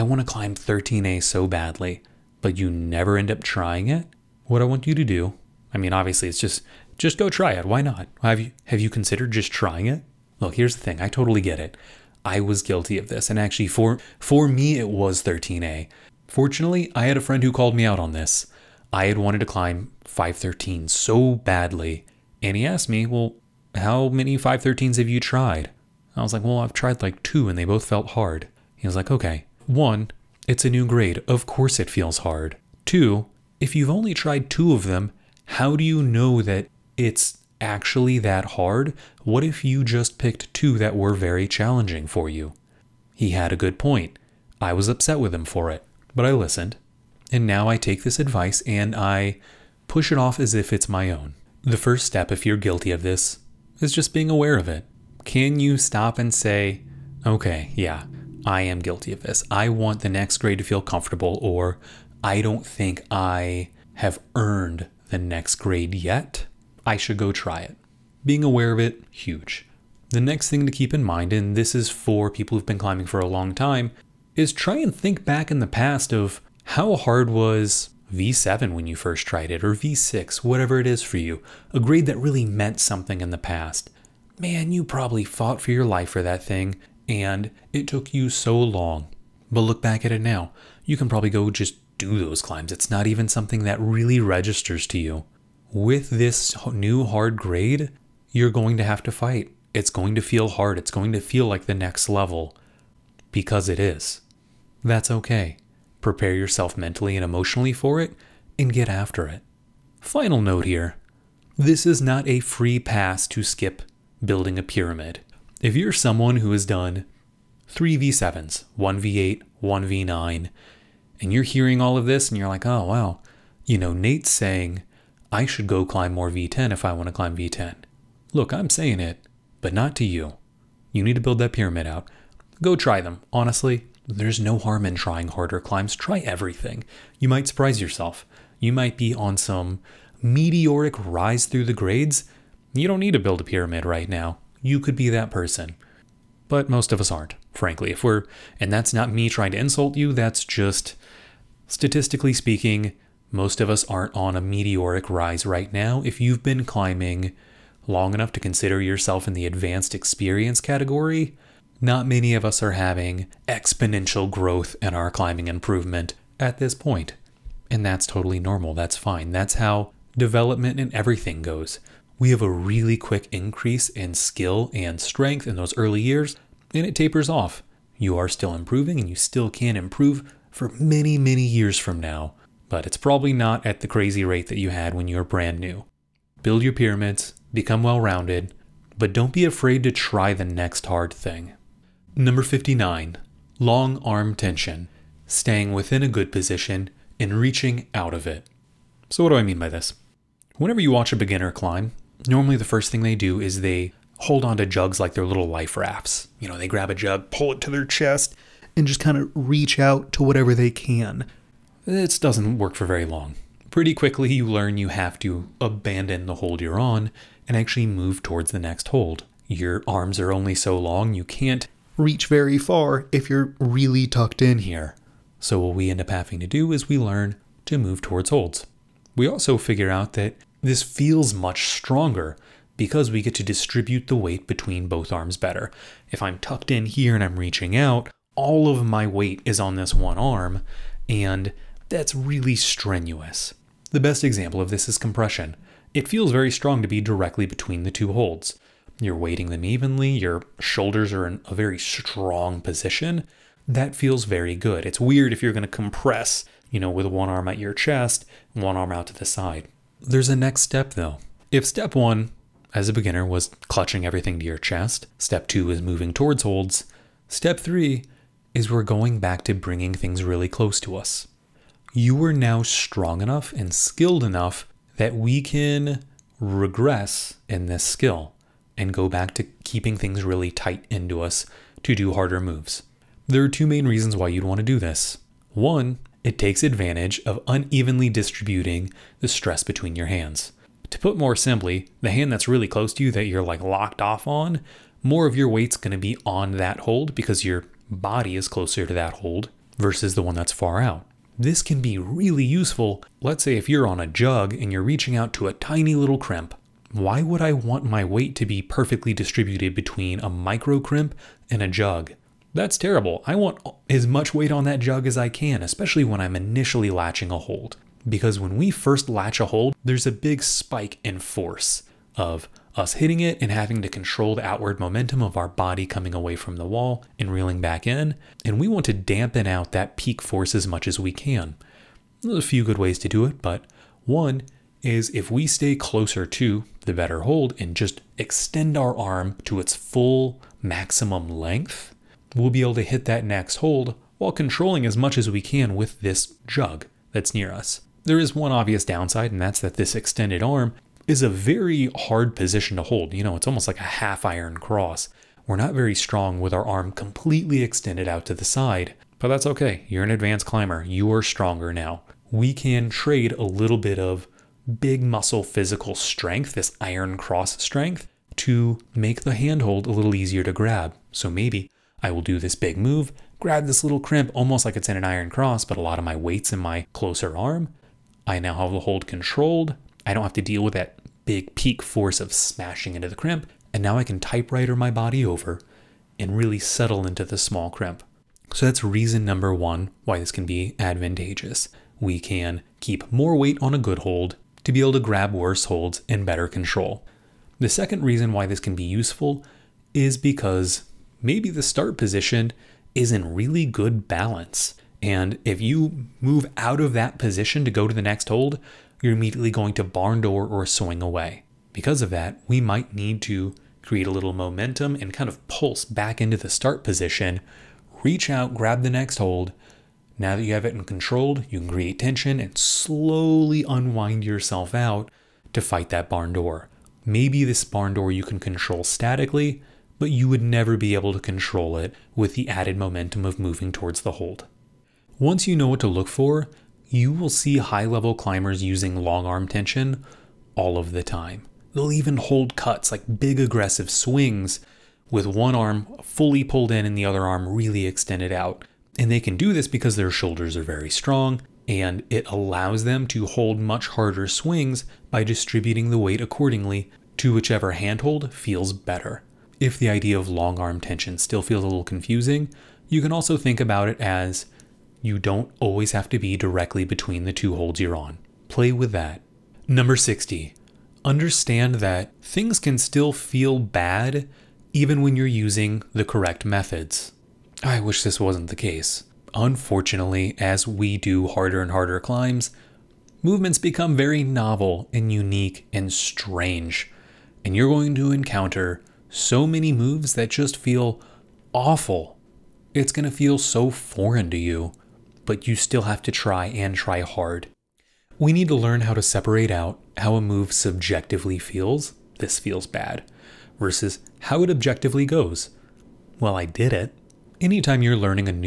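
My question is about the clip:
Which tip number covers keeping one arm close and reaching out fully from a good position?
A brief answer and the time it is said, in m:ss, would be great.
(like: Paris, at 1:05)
59, at 3:12.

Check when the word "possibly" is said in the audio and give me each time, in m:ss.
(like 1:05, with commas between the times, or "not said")
not said.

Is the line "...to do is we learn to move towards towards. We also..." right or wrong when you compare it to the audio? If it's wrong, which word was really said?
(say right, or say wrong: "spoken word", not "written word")
wrong: "holds", not "towards".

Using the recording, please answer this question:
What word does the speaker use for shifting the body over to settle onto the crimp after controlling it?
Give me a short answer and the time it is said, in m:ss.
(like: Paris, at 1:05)
Typewriter, at 6:24.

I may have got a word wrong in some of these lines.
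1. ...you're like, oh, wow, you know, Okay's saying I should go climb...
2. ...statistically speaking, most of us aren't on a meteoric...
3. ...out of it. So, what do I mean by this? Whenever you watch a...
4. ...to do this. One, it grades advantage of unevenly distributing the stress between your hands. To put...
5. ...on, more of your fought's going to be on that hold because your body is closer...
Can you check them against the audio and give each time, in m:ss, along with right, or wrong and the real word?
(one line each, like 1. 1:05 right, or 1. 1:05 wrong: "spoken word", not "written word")
1. 2:02 wrong: "Nate", not "Okay"
2. 2:31 right
3. 3:17 right
4. 4:44 wrong: "takes", not "grades"
5. 4:54 wrong: "weight", not "fought".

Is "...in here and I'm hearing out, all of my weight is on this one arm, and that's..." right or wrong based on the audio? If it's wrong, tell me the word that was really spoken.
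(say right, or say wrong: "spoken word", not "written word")
wrong: "reaching", not "hearing".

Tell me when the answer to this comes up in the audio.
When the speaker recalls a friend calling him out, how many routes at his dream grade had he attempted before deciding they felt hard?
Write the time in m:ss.
0:26.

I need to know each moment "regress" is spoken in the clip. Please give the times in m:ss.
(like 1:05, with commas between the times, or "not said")
4:36.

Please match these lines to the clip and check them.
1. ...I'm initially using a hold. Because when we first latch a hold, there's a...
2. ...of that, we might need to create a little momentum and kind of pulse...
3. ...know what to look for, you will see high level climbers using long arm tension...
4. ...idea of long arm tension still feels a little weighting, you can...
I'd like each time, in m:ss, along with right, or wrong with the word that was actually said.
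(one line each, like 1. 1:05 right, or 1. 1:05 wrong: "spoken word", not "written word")
1. 5:16 wrong: "latching", not "using"
2. 6:52 right
3. 7:15 right
4. 7:39 wrong: "confusing", not "weighting".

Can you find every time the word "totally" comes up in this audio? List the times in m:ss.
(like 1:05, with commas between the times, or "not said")
0:11, 2:48.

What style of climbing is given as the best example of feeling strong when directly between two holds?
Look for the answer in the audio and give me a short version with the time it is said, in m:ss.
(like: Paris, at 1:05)
Compression, at 4:04.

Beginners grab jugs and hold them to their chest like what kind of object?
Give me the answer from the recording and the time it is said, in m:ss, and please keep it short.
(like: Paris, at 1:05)
Life rafts, at 3:25.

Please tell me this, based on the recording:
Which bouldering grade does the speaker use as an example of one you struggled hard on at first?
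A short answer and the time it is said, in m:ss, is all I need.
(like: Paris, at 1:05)
V7, at 1:18.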